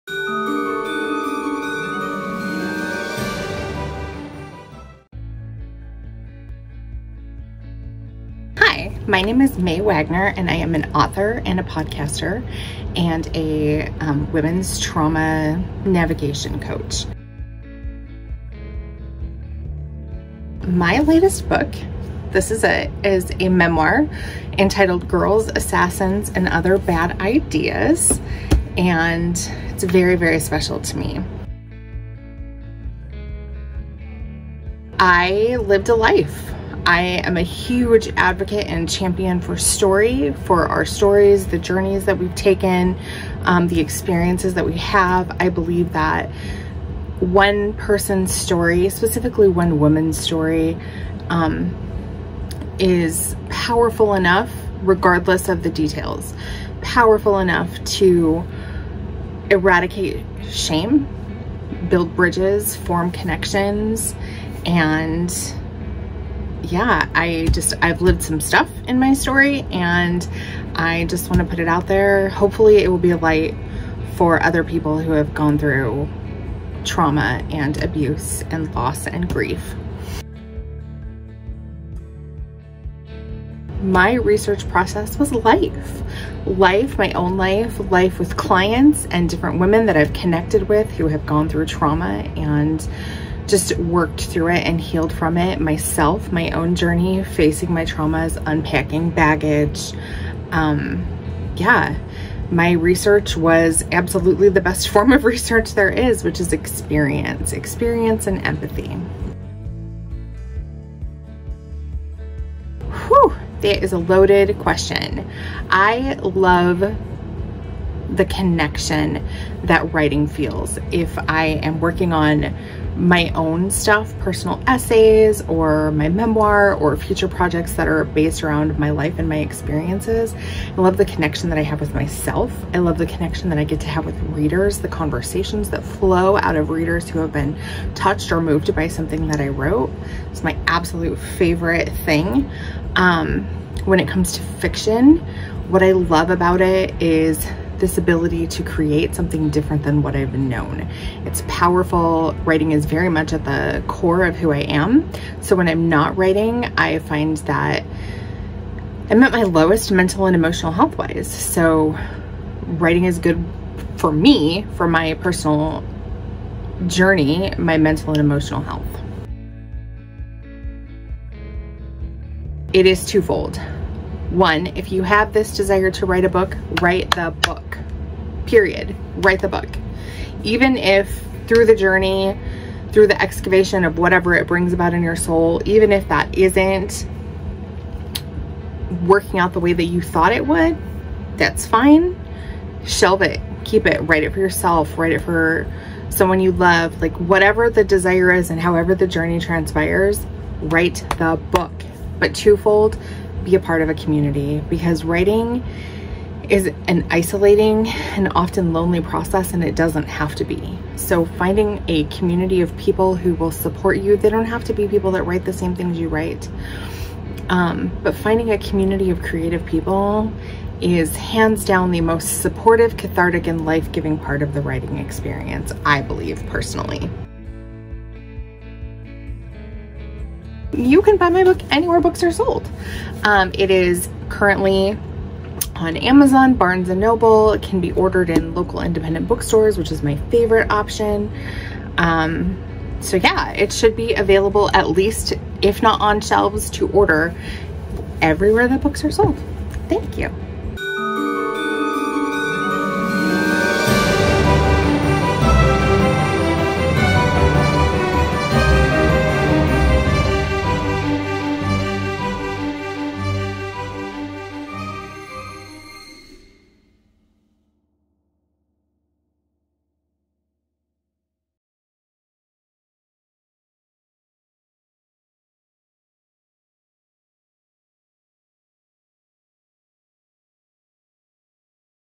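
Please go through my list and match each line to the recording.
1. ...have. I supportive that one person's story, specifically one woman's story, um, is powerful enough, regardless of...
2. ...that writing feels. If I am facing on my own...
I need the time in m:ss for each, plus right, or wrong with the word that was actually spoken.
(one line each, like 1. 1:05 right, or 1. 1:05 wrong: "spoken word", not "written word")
1. 0:44 wrong: "believe", not "supportive"
2. 1:59 wrong: "working", not "facing".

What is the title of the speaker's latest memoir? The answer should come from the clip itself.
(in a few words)
Girls, Assassins, and Other Bad Ideas.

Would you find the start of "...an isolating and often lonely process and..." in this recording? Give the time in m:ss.
3:26.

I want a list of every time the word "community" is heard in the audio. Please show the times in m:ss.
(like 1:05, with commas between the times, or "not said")
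3:23, 3:32, 3:38.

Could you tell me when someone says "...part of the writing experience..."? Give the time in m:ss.
3:44.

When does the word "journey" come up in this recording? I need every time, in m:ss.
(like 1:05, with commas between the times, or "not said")
0:41, 1:36, 2:46, 3:01, 3:19.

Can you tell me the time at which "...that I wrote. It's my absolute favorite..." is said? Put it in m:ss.
2:19.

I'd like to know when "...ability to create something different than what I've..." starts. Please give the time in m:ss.
2:27.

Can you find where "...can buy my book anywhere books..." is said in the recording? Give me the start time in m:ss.
3:51.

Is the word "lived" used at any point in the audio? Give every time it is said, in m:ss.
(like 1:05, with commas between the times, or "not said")
0:35, 1:08.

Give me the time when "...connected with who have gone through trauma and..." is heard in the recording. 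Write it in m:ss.
1:30.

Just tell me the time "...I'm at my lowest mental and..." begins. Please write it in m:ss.
2:39.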